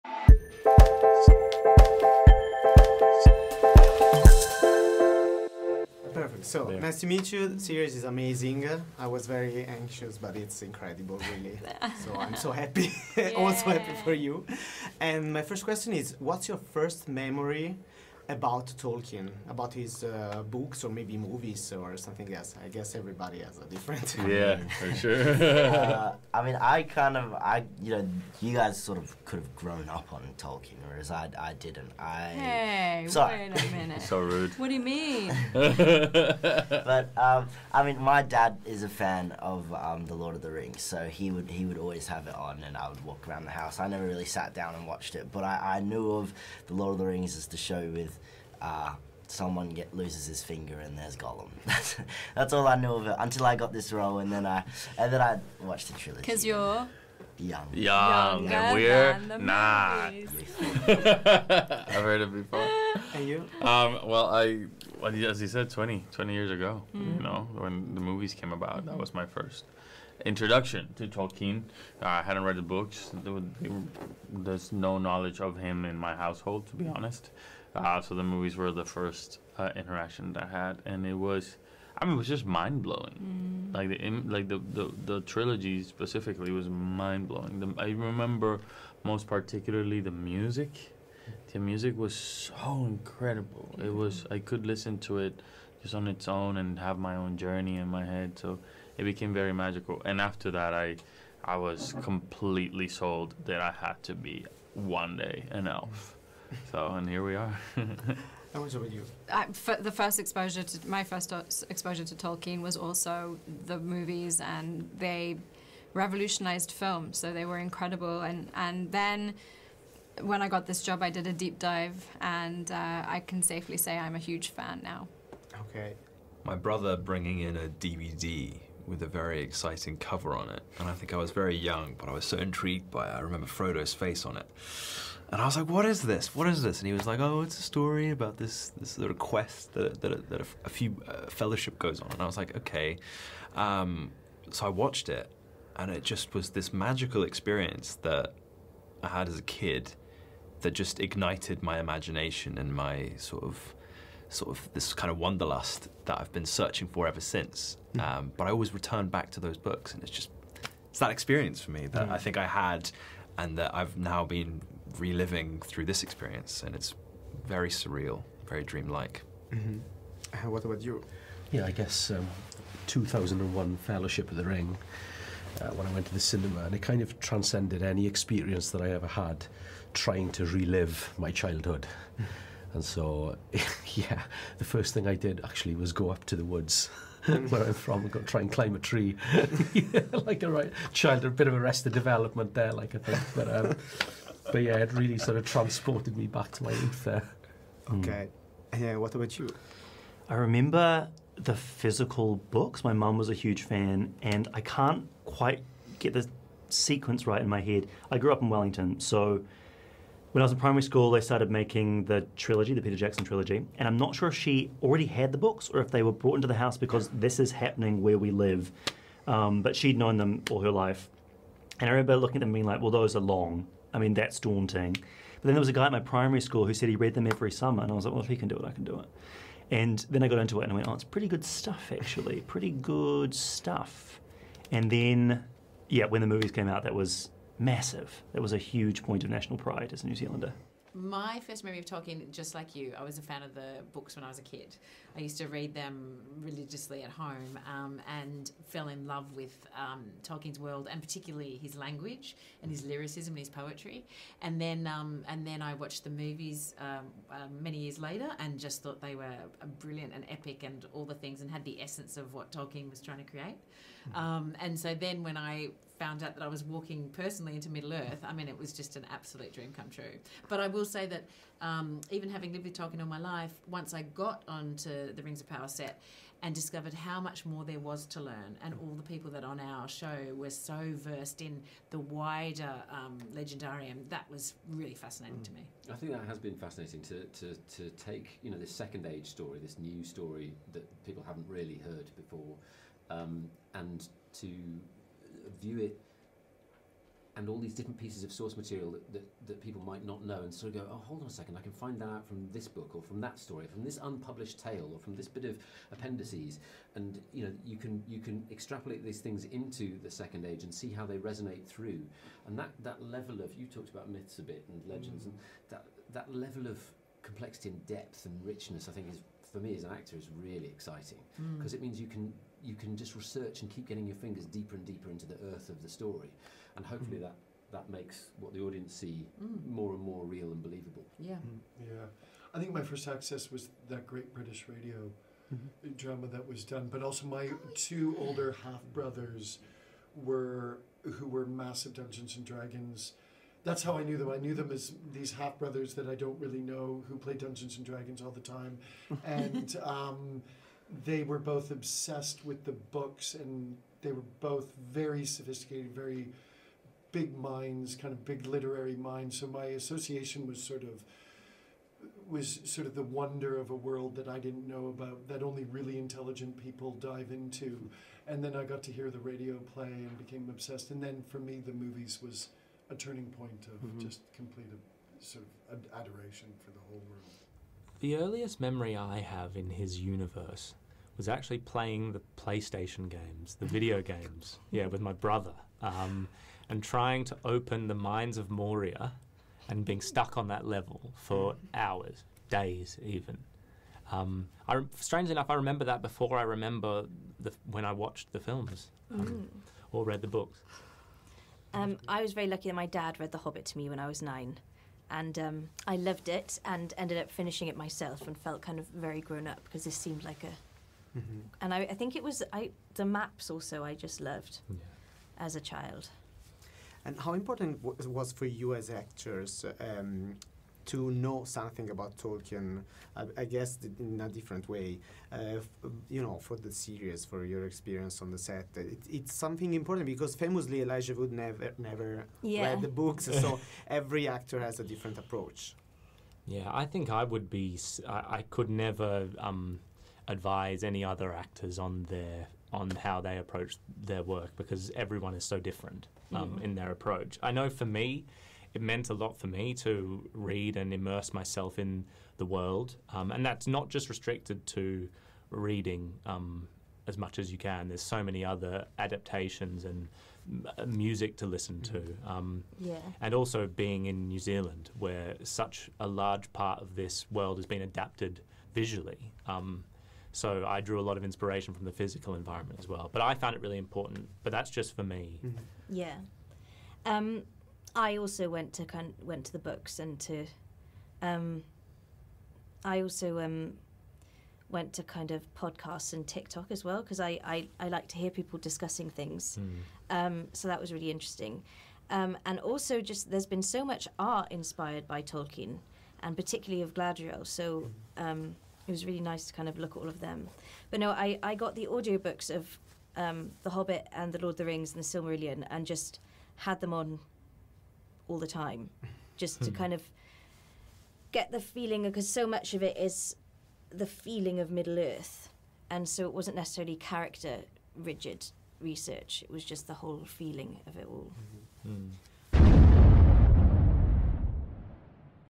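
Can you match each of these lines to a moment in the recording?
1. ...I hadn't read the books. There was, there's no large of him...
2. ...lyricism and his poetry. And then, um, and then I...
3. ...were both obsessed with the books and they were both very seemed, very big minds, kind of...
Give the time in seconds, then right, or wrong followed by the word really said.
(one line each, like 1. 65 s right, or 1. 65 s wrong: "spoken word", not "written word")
1. 72 s wrong: "knowledge", not "large"
2. 252 s right
3. 351 s wrong: "sophisticated", not "seemed".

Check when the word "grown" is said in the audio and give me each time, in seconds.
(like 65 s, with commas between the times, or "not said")
29 s, 409 s.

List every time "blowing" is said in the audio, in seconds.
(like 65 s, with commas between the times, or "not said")
82 s, 87 s.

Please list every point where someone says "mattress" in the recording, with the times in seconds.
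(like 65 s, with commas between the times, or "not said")
not said.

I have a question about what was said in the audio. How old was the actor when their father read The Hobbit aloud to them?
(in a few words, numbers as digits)
9.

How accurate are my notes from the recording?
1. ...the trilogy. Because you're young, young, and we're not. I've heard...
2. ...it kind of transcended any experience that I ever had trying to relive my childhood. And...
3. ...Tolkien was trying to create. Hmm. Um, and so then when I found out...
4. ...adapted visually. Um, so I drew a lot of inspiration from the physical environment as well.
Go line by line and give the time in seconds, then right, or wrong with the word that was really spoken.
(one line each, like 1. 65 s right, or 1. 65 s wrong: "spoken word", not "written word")
1. 55 s right
2. 176 s right
3. 262 s right
4. 467 s right.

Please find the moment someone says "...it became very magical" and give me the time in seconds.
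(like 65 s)
98 s.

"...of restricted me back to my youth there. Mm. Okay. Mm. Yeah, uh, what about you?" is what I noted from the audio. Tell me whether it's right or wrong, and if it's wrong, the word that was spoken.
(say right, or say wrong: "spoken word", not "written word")
wrong: "transported", not "restricted".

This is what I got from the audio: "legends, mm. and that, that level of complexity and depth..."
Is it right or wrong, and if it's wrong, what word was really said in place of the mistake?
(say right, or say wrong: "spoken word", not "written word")
right.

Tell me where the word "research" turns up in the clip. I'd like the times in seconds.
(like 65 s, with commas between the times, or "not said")
323 s, 518 s.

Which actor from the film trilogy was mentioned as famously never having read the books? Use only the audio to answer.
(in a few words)
Elijah Wood.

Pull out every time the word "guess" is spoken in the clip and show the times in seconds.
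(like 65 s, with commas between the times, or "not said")
22 s, 171 s, 423 s.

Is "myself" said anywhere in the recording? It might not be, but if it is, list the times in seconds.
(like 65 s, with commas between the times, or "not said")
407 s, 451 s.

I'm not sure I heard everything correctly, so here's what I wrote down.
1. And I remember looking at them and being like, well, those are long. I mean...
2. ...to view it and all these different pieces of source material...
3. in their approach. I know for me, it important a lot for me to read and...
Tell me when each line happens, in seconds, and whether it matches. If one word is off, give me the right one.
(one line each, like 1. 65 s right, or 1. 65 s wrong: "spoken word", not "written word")
1. 221 s right
2. 294 s right
3. 446 s wrong: "meant", not "important".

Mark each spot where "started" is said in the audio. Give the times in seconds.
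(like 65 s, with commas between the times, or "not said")
211 s.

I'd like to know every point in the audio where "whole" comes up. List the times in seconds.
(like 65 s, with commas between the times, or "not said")
376 s, 519 s.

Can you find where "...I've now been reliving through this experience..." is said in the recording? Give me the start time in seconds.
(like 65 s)
163 s.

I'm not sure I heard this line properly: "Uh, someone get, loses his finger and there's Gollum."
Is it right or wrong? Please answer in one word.
right.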